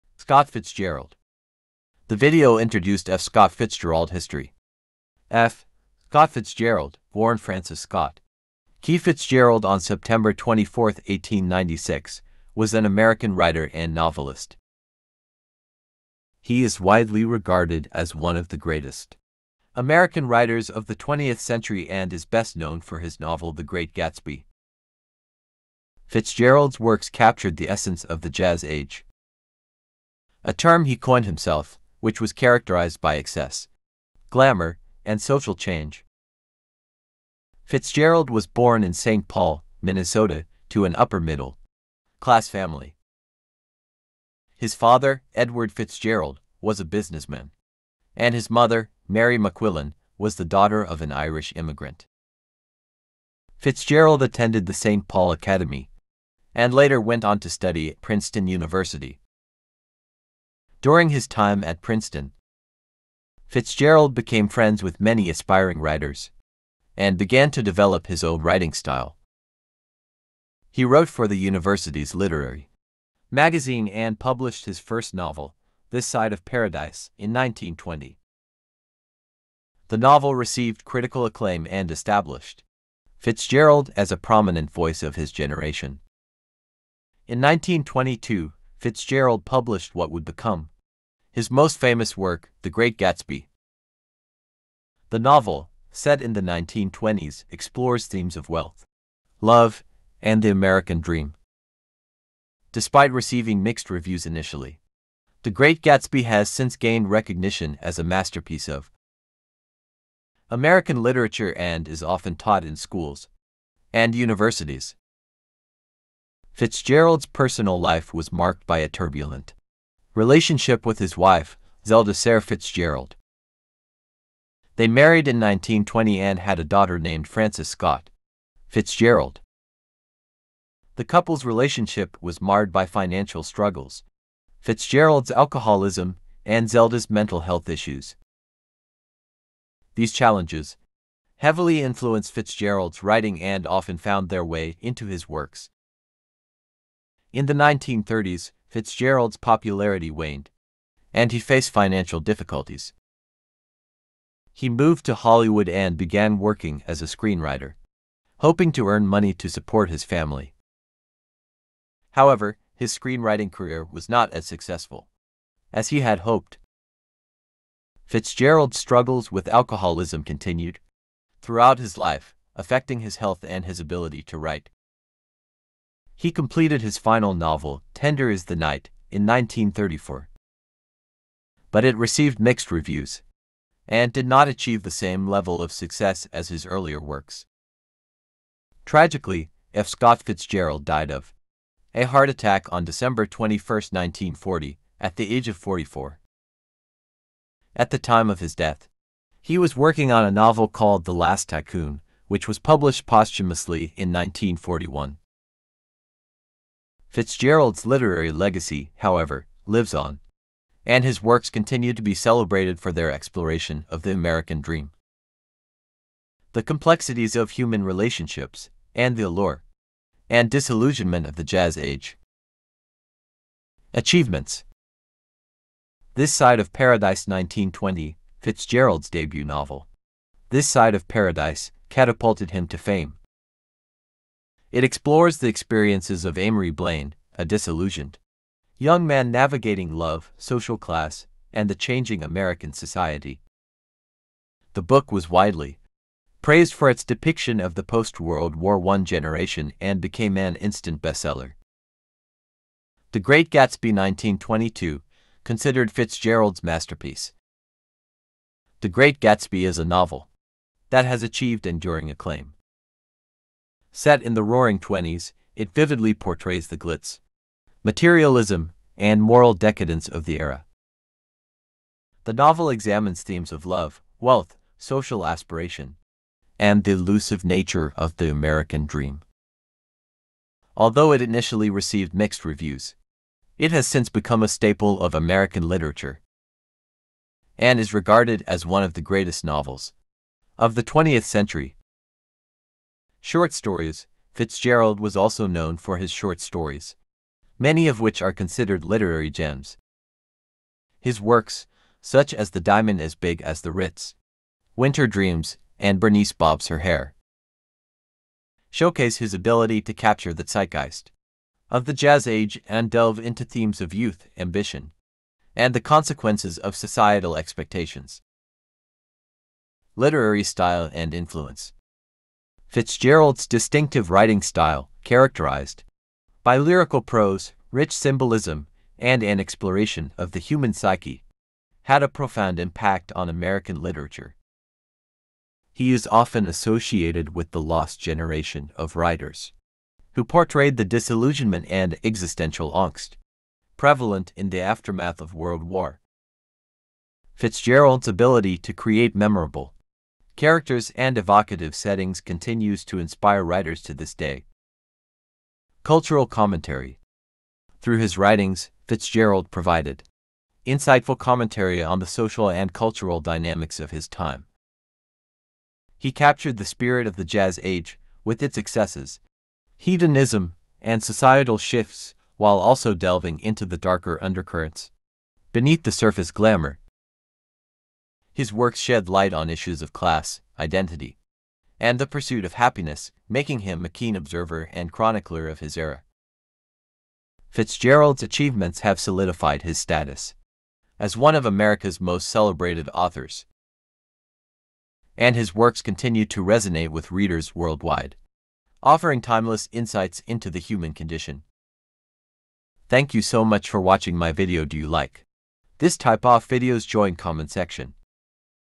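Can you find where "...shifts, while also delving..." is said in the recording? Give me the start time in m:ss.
6:11.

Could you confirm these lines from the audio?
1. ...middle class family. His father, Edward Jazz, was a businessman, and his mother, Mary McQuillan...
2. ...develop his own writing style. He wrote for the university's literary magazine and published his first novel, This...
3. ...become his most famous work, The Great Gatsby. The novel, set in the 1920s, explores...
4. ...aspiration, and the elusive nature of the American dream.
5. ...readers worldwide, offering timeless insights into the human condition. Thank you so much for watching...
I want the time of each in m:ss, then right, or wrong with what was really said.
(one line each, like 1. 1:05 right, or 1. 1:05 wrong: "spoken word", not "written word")
1. 0:41 wrong: "Fitzgerald", not "Jazz"
2. 1:07 right
3. 1:30 right
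4. 4:35 right
5. 6:37 right.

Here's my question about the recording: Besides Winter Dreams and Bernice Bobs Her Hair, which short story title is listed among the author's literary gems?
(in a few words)
The Diamond as Big as the Ritz.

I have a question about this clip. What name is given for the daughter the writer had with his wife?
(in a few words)
Frances Scott Fitzgerald.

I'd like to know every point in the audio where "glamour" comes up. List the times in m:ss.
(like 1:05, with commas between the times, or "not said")
0:34, 6:16.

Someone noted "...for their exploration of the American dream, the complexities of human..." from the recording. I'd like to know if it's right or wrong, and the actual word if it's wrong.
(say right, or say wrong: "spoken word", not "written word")
right.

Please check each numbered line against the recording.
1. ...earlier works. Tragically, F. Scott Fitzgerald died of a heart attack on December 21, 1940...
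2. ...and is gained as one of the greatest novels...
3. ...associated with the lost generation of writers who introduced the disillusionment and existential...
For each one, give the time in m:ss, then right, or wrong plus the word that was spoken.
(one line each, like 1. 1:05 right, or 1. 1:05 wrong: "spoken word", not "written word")
1. 3:06 right
2. 4:47 wrong: "regarded", not "gained"
3. 5:36 wrong: "portrayed", not "introduced".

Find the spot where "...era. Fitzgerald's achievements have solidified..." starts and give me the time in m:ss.
6:25.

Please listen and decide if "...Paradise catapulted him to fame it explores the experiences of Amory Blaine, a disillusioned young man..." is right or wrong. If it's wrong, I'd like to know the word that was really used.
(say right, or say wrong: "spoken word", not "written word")
right.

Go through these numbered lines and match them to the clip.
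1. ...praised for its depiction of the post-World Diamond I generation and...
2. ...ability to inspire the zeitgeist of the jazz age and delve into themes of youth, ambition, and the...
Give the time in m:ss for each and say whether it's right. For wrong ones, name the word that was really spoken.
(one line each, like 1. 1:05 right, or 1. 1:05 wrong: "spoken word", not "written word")
1. 4:06 wrong: "War", not "Diamond"
2. 5:09 wrong: "capture", not "inspire".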